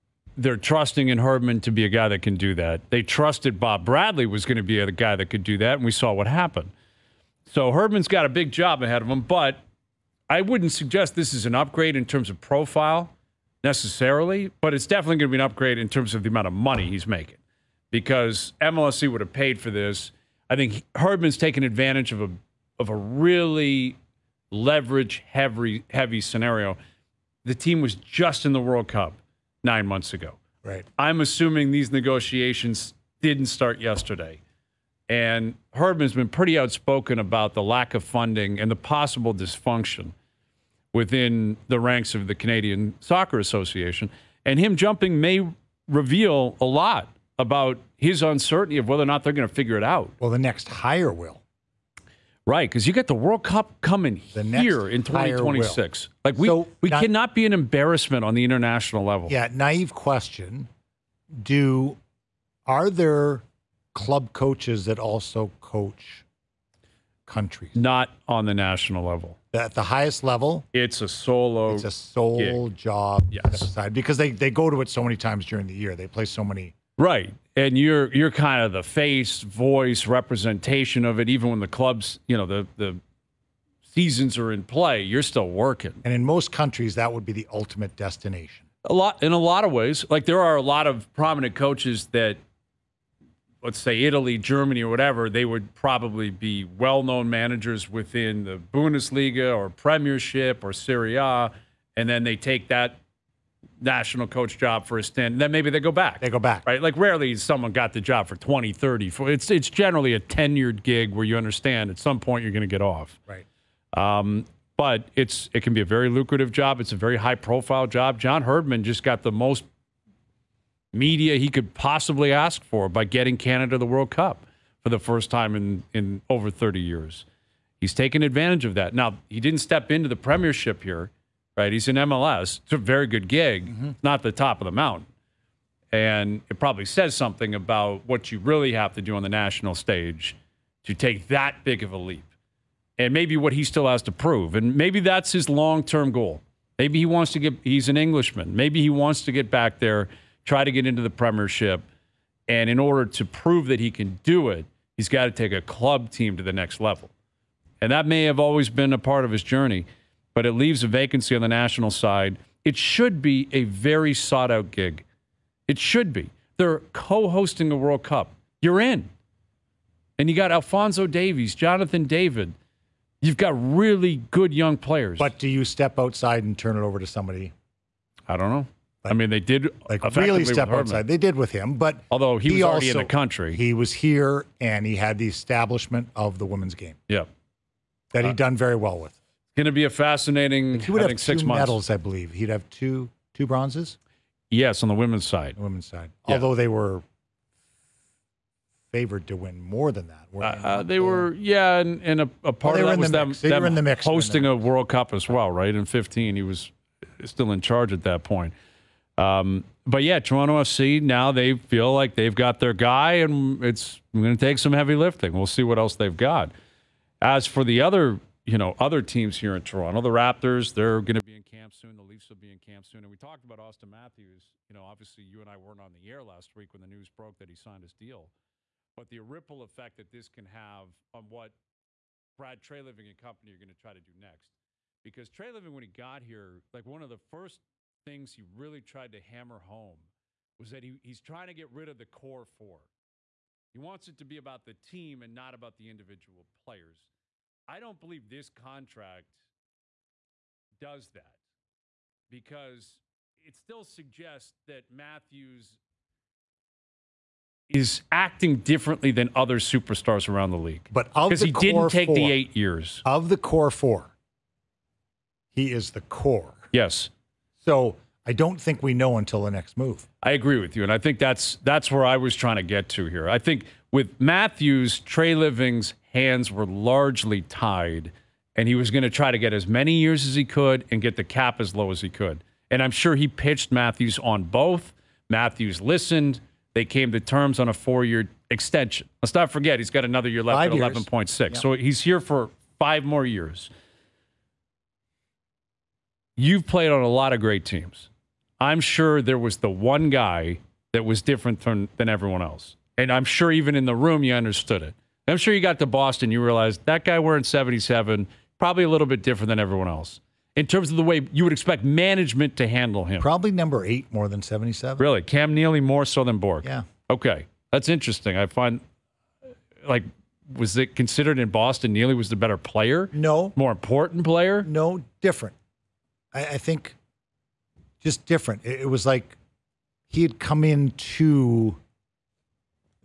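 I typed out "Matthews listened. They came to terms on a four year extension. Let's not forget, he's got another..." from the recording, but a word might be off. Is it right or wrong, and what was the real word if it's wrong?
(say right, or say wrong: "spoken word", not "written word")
right.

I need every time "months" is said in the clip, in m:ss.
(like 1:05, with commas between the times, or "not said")
0:29, 3:11.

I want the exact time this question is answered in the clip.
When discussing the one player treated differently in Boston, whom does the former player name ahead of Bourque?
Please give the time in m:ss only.
5:15.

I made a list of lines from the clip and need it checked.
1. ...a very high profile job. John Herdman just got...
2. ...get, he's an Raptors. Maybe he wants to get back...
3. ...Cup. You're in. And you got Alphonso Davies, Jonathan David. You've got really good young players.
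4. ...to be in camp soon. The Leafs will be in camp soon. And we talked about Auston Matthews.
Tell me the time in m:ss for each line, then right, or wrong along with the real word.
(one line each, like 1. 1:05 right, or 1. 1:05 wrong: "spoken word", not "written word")
1. 1:56 right
2. 2:27 wrong: "Englishman", not "Raptors"
3. 2:48 right
4. 3:41 right.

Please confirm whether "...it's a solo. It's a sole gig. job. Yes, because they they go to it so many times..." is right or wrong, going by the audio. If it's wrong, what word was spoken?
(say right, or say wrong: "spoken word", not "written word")
right.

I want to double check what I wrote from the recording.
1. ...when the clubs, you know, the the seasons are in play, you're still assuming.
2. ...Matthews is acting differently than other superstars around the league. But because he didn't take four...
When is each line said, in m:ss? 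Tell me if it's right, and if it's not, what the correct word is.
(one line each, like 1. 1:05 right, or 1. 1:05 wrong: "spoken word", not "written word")
1. 1:21 wrong: "working", not "assuming"
2. 4:14 right.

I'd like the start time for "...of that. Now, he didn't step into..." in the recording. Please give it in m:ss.
2:08.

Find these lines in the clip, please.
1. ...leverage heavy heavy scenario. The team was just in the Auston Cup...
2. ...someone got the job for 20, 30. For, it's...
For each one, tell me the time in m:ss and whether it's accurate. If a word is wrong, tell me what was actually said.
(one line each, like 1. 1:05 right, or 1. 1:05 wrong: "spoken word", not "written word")
1. 0:24 wrong: "World", not "Auston"
2. 1:47 right.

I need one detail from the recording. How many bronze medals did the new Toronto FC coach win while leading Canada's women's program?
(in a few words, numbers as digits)
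2.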